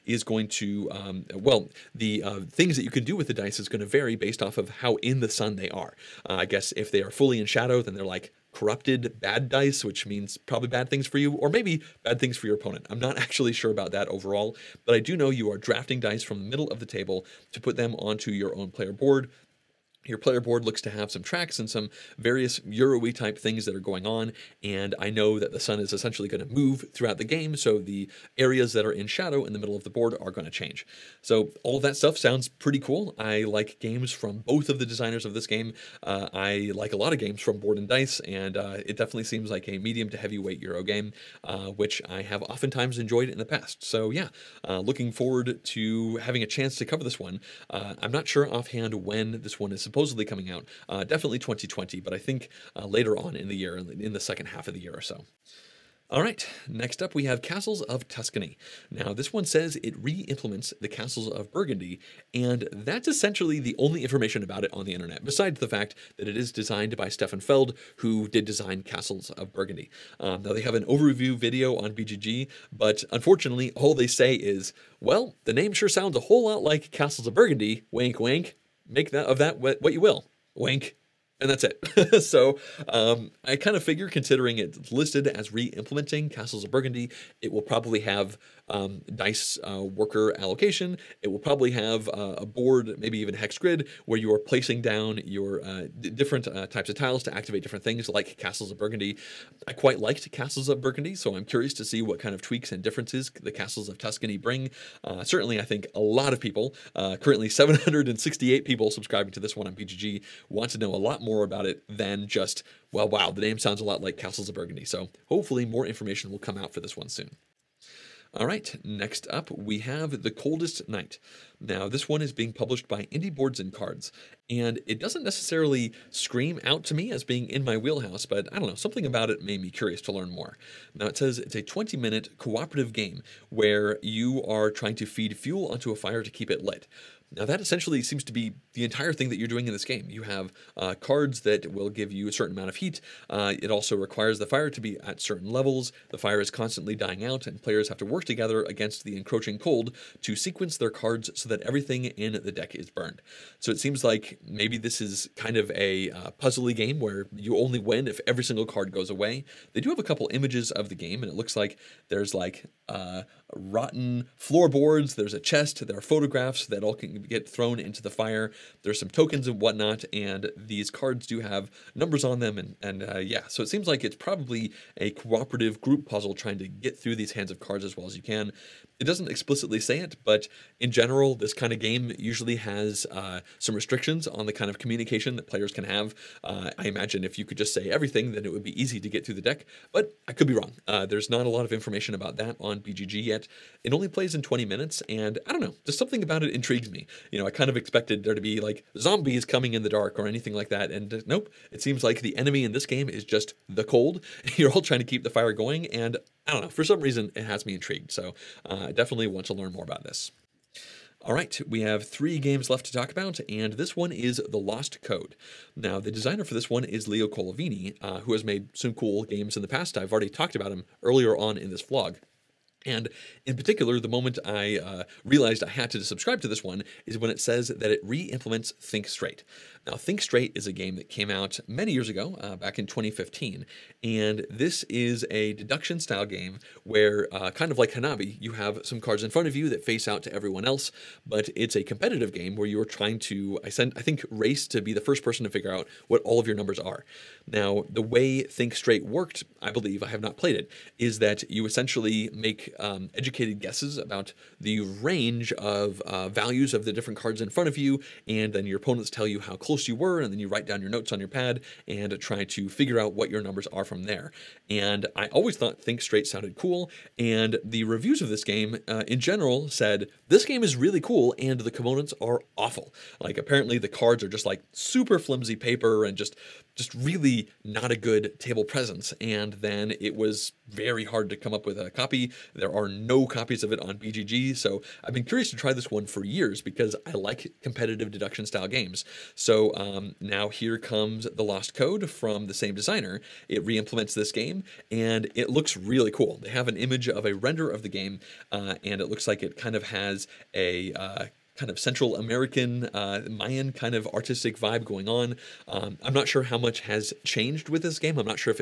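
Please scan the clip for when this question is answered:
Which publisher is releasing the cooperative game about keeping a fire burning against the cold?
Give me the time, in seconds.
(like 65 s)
123 s.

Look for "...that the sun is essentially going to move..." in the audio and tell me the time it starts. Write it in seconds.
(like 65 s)
25 s.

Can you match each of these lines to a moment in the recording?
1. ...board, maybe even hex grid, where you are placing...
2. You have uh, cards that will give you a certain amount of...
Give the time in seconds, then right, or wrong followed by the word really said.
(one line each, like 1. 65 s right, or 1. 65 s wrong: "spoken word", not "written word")
1. 92 s right
2. 140 s right.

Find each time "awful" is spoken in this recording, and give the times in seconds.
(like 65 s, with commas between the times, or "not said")
272 s.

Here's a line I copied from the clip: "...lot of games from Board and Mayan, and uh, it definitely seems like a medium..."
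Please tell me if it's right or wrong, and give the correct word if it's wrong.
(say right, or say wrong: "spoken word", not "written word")
wrong: "Dice", not "Mayan".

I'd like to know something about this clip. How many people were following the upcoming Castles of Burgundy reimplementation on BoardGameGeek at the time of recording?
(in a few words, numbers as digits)
768.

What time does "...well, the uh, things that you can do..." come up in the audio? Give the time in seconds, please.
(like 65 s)
1 s.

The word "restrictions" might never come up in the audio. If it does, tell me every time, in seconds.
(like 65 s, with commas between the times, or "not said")
183 s.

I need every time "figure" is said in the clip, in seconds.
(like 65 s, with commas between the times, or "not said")
83 s, 245 s, 262 s.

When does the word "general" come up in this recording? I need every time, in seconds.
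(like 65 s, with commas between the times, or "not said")
180 s, 269 s.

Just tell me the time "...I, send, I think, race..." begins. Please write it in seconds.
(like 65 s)
243 s.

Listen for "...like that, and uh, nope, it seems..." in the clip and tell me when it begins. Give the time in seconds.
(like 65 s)
200 s.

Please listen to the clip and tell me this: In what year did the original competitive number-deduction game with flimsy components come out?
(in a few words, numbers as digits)
2015.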